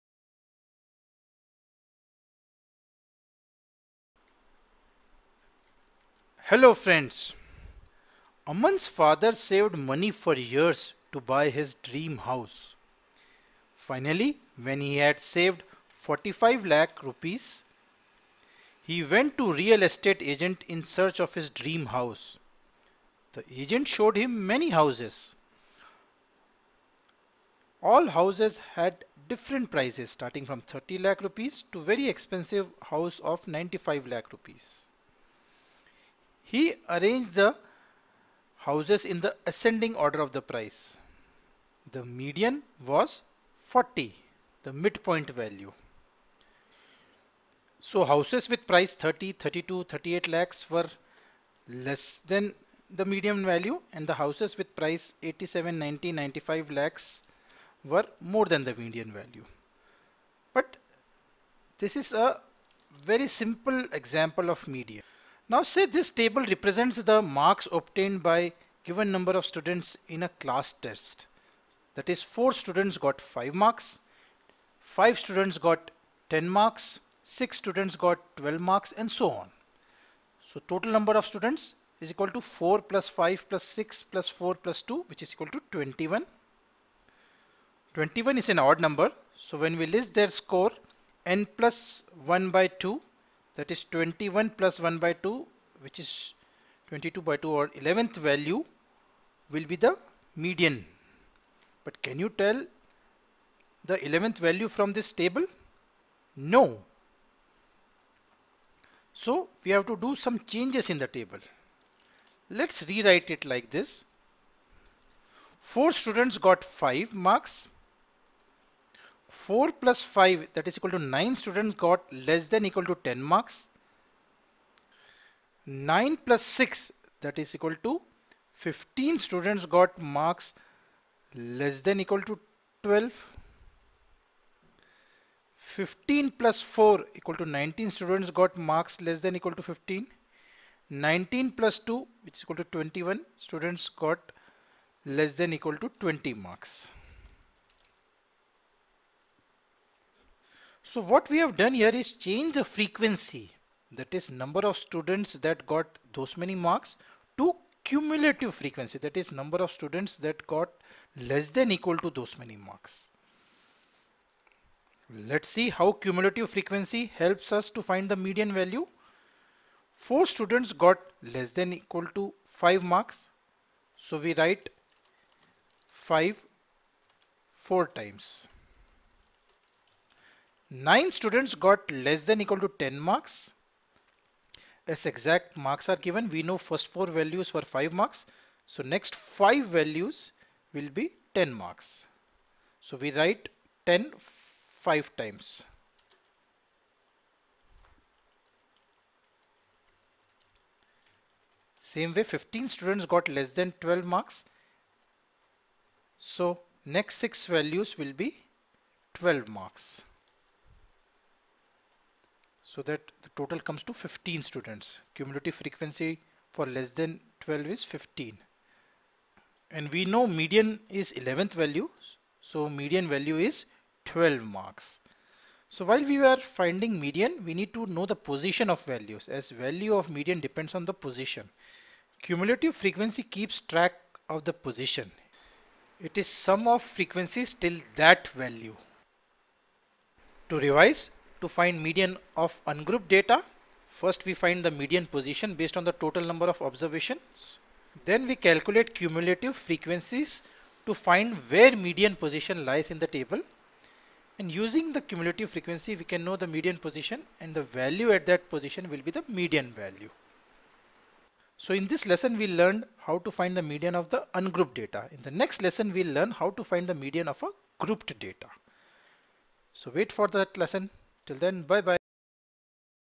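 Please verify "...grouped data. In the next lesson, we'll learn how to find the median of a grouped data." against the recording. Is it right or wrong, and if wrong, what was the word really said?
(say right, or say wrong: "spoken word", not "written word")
wrong: "ungrouped", not "grouped".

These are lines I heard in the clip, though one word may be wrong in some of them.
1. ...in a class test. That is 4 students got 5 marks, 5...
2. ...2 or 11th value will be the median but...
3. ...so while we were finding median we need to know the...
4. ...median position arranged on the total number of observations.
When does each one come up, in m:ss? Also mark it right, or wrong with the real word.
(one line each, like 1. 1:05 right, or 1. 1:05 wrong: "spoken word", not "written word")
1. 1:10 right
2. 1:37 right
3. 3:45 right
4. 4:04 wrong: "based", not "arranged".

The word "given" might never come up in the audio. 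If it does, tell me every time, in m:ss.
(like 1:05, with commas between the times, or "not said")
1:08, 3:05.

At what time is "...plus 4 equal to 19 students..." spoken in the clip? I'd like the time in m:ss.
2:16.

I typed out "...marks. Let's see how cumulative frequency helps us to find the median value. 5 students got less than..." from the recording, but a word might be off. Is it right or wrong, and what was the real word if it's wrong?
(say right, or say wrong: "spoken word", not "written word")
wrong: "4", not "5".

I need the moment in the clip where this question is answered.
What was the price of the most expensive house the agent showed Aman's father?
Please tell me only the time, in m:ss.
0:33.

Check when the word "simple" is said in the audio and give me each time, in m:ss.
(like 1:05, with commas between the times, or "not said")
1:03.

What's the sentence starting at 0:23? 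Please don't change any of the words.
The agent showed him many houses.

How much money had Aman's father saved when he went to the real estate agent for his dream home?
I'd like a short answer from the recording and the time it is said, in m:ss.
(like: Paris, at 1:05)
45 lakh rupees, at 0:16.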